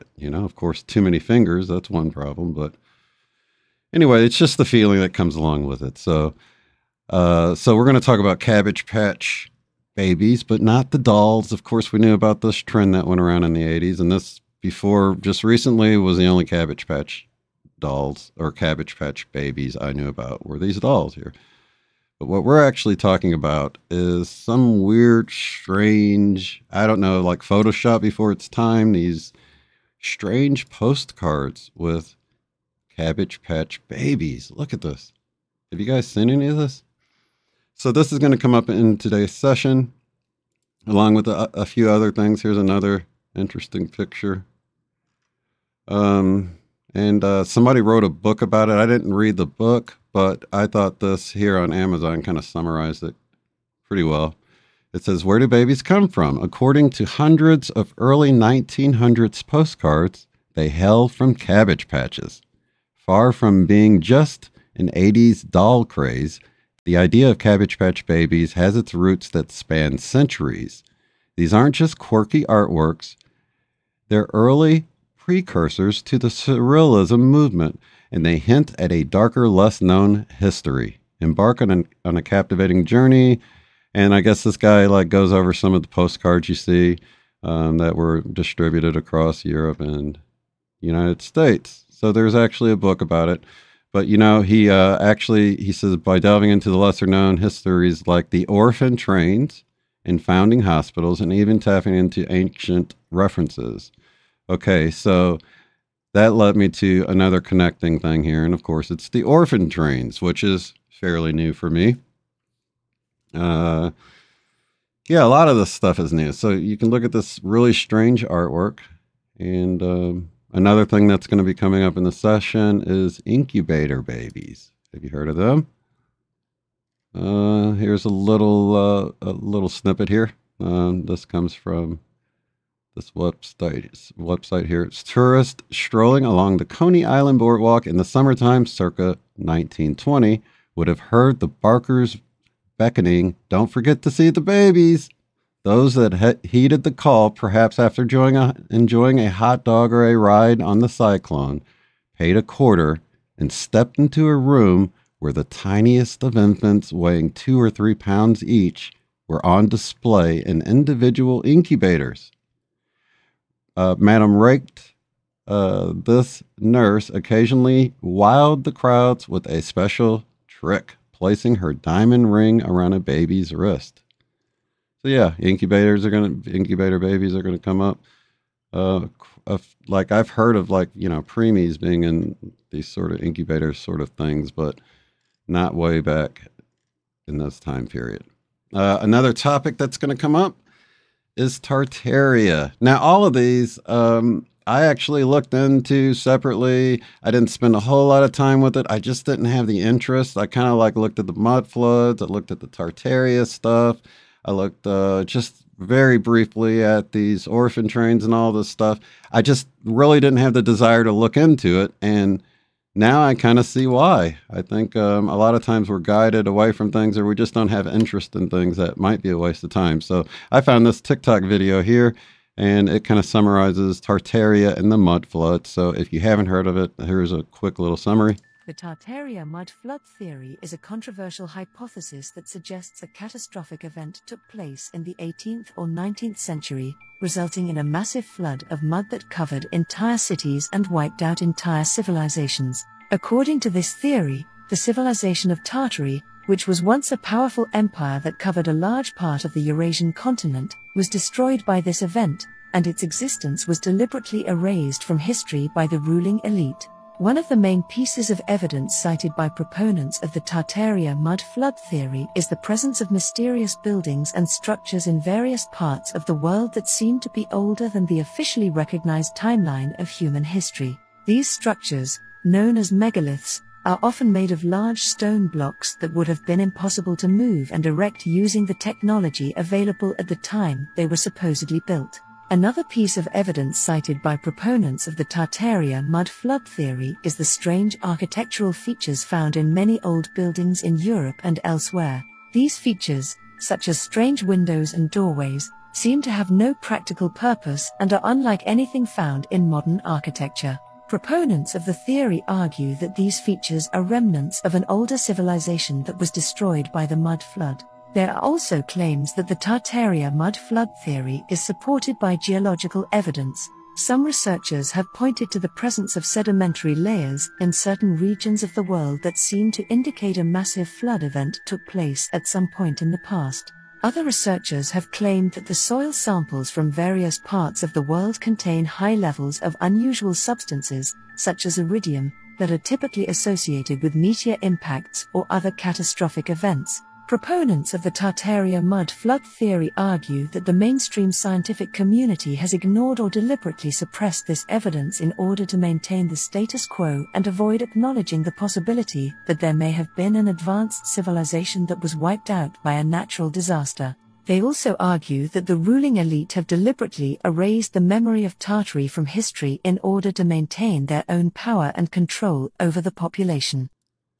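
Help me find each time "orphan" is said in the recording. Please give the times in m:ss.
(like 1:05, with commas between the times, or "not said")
1:38, 1:49, 3:27.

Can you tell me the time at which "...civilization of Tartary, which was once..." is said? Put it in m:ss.
4:04.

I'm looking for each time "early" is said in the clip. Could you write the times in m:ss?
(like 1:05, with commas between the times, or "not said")
0:57, 1:14.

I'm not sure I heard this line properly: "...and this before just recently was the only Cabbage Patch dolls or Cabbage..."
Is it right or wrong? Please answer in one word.
right.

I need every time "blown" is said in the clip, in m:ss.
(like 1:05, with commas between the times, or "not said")
not said.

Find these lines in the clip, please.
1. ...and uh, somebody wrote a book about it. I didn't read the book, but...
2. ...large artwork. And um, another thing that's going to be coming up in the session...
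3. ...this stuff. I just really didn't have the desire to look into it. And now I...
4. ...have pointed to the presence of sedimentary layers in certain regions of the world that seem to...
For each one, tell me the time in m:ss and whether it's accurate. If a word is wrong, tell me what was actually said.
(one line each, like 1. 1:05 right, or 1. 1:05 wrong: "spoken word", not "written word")
1. 0:46 right
2. 1:57 wrong: "strange", not "large"
3. 3:28 right
4. 5:14 right.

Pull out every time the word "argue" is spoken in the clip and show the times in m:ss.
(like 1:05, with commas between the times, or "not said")
5:02, 5:39, 5:54.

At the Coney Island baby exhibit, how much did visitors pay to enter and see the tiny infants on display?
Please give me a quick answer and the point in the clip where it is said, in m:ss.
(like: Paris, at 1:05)
a quarter, at 2:32.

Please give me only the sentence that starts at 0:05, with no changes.
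So, uh, so we're going to talk about Cabbage Patch Babies, but not the dolls.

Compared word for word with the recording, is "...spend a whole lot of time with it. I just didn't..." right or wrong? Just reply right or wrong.
right.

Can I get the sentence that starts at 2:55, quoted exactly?
So yeah, incubators are gonna incubator babies are gonna come up.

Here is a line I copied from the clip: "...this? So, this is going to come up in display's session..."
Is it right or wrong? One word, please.
wrong.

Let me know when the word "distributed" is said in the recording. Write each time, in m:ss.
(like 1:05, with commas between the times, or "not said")
1:28.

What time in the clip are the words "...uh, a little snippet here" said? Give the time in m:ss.
2:08.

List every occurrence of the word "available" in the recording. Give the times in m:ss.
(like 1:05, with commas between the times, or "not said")
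4:39.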